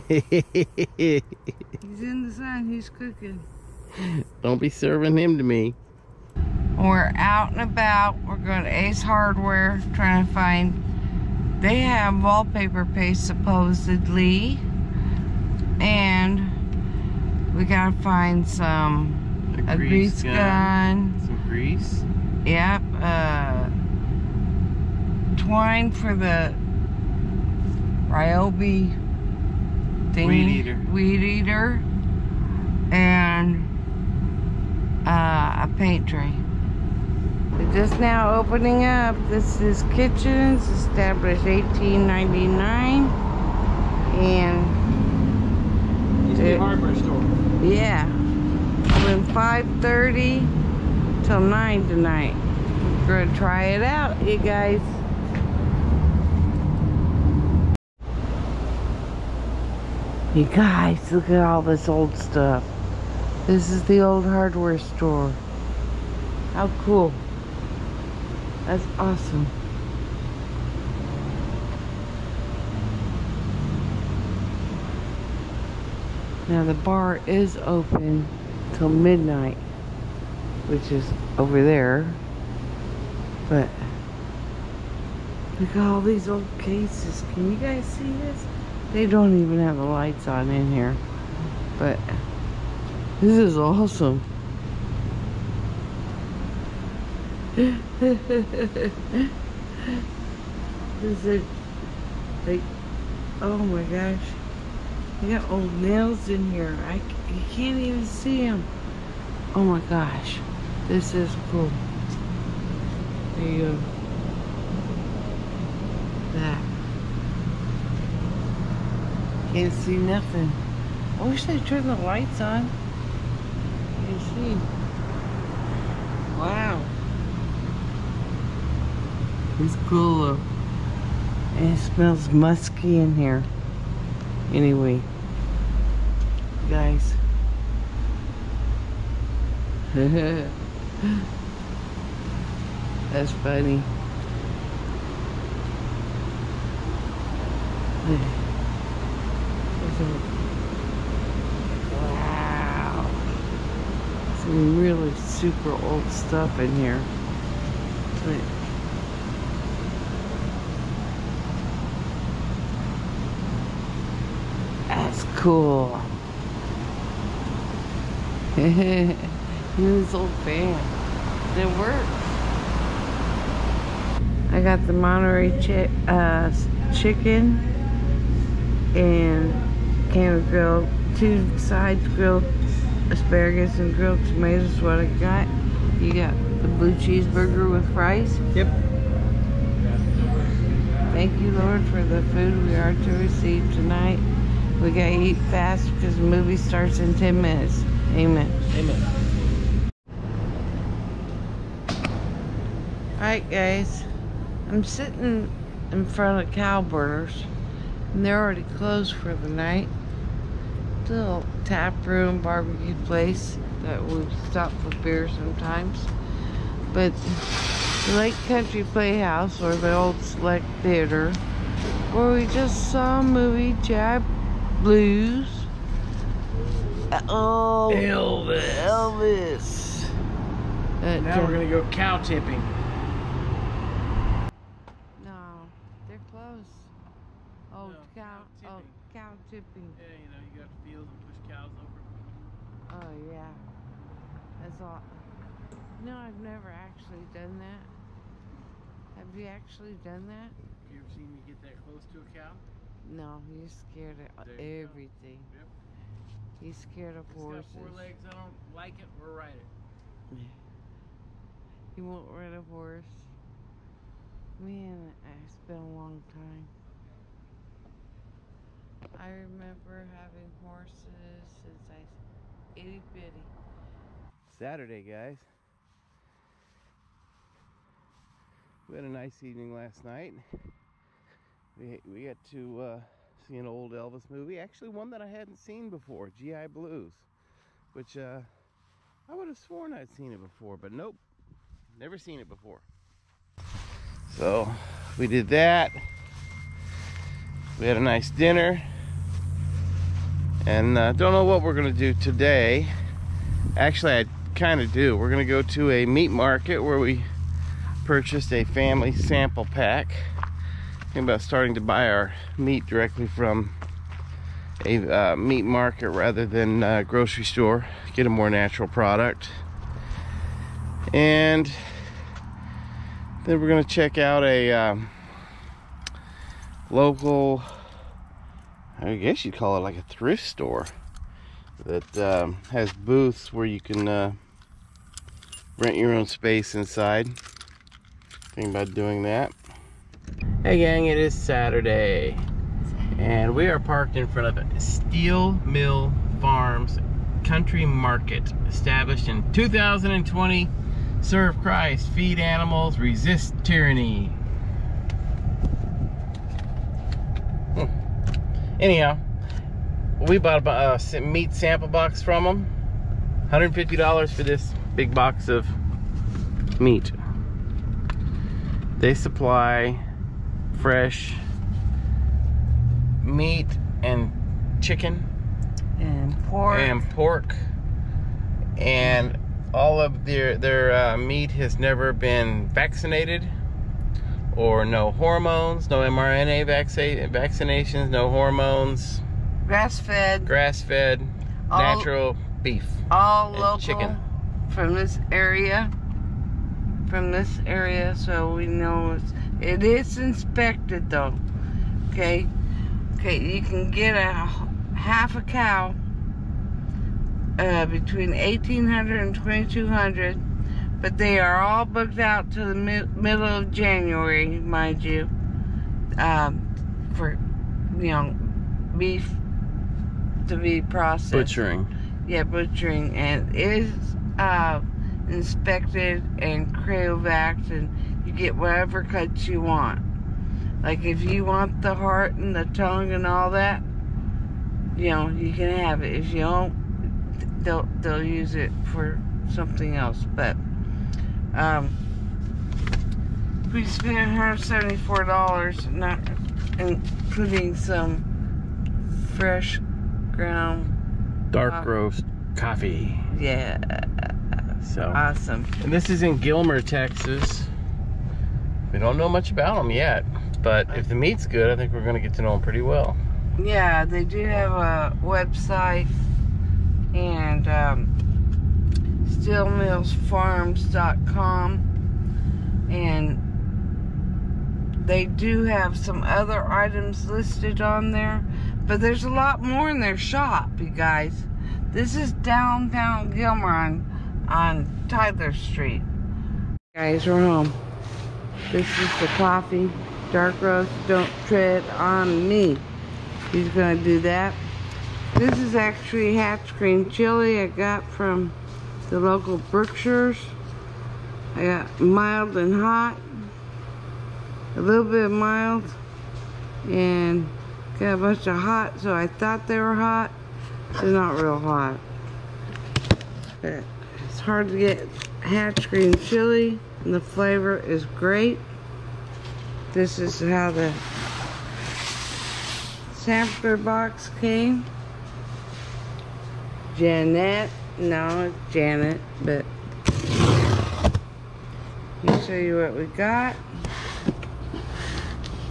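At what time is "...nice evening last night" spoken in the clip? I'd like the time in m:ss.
4:39.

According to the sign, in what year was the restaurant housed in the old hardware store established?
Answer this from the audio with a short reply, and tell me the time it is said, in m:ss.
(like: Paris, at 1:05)
1899, at 0:41.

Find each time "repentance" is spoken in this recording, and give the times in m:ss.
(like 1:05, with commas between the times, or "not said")
not said.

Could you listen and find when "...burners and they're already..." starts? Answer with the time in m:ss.
3:26.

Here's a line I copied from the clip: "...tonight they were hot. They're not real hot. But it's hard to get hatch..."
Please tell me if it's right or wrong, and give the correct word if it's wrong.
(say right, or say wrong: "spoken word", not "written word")
wrong: "thought", not "tonight".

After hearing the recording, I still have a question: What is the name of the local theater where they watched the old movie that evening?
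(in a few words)
Lake Country Playhouse.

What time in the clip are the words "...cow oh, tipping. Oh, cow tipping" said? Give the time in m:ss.
3:58.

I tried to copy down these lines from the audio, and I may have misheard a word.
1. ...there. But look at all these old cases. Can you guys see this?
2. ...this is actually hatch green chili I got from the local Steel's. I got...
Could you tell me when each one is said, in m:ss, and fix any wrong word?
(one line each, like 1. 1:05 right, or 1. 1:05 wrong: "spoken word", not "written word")
1. 1:21 right
2. 8:15 wrong: "Brookshire", not "Steel".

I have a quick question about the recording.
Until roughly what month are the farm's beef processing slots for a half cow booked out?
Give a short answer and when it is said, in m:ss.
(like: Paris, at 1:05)
January, at 6:53.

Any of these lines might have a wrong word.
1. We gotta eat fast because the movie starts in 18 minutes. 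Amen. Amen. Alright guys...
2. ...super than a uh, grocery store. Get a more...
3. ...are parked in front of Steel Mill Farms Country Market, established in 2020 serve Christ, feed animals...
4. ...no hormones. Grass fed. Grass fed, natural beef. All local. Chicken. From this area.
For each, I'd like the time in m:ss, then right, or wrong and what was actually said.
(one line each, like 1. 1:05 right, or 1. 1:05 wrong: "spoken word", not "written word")
1. 3:14 wrong: "10", not "18"
2. 5:16 wrong: "rather", not "super"
3. 5:43 right
4. 6:28 right.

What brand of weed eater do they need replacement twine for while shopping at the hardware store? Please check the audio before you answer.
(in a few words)
Ryobi.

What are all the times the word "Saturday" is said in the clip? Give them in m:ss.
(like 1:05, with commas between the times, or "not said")
4:34, 5:41.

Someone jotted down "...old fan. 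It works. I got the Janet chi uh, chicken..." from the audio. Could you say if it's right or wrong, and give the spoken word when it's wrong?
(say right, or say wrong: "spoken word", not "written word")
wrong: "Monterey", not "Janet".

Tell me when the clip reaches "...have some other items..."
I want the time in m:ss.
7:55.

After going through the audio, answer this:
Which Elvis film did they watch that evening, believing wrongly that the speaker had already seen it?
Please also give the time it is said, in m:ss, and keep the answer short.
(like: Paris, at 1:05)
G.I. Blues, at 4:46.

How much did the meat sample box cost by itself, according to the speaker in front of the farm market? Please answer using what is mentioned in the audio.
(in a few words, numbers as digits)
$150.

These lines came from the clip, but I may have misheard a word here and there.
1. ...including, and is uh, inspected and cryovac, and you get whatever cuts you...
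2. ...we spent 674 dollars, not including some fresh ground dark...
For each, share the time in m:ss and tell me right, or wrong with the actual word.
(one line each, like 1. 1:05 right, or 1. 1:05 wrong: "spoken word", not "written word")
1. 7:02 wrong: "butchering", not "including"
2. 7:23 wrong: "174", not "674".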